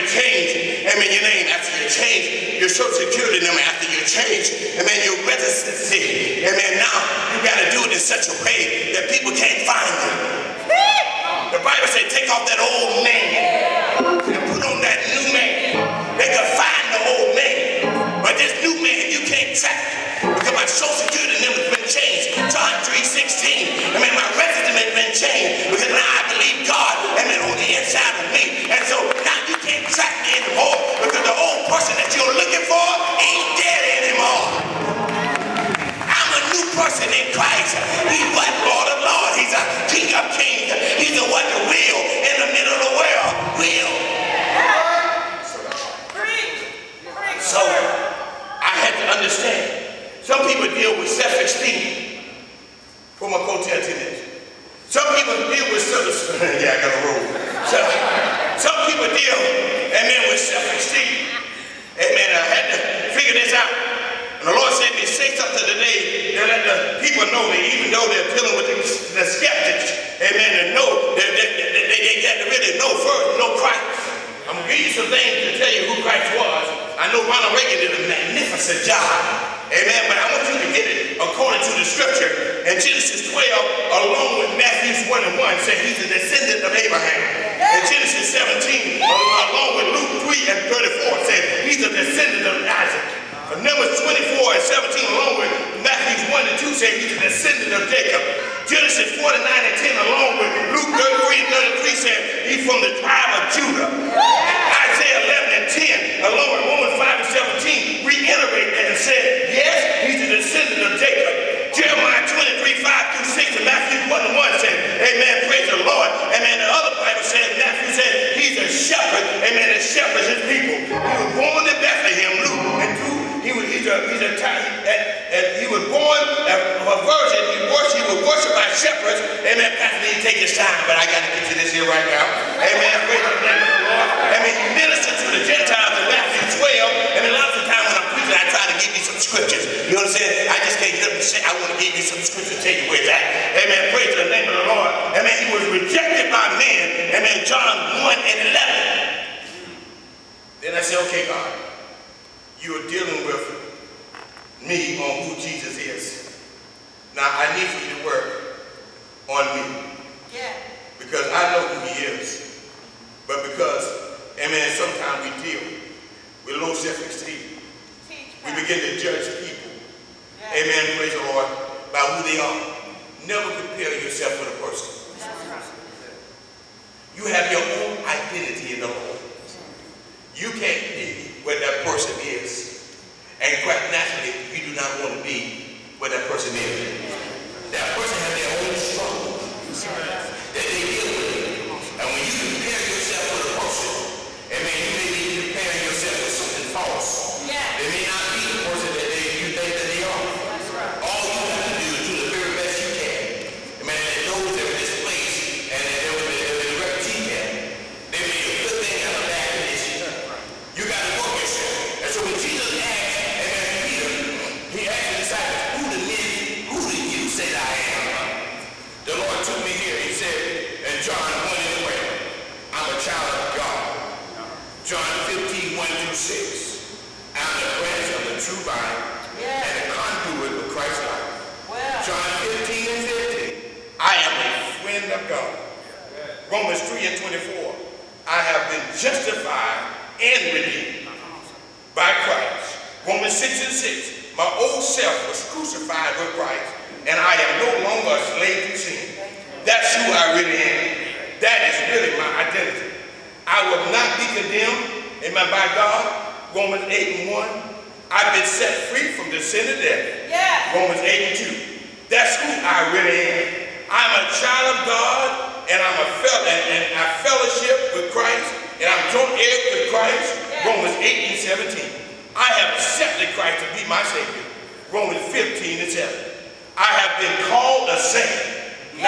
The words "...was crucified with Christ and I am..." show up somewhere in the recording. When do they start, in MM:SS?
04:05.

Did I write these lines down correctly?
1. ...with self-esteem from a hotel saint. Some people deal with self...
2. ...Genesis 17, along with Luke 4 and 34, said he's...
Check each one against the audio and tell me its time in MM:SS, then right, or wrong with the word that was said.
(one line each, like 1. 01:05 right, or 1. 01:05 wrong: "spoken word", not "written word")
1. 00:50 wrong: "tenant", not "saint"
2. 01:27 wrong: "3", not "4".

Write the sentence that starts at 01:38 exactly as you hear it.
Genesis 49 and 10 along with Luke 33 and 33 said he's from the tribe of Judah.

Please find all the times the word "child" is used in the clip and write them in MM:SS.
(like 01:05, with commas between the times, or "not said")
03:42, 04:24.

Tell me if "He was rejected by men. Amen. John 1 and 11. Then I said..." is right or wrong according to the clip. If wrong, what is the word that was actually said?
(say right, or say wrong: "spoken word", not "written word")
right.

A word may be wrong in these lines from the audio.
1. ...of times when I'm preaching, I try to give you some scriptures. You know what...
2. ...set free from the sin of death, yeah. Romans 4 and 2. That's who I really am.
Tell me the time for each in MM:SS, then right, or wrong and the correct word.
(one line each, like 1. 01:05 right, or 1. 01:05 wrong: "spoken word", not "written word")
1. 02:17 right
2. 04:18 wrong: "8", not "4".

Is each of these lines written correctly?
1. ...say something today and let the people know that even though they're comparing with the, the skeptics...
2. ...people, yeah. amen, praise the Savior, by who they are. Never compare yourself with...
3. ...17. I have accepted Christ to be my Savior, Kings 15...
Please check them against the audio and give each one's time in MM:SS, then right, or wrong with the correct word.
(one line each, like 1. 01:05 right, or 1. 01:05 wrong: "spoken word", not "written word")
1. 01:05 wrong: "dealing", not "comparing"
2. 02:49 wrong: "Lord", not "Savior"
3. 04:31 wrong: "Romans", not "Kings".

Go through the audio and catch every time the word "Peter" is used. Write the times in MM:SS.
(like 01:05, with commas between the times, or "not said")
03:33.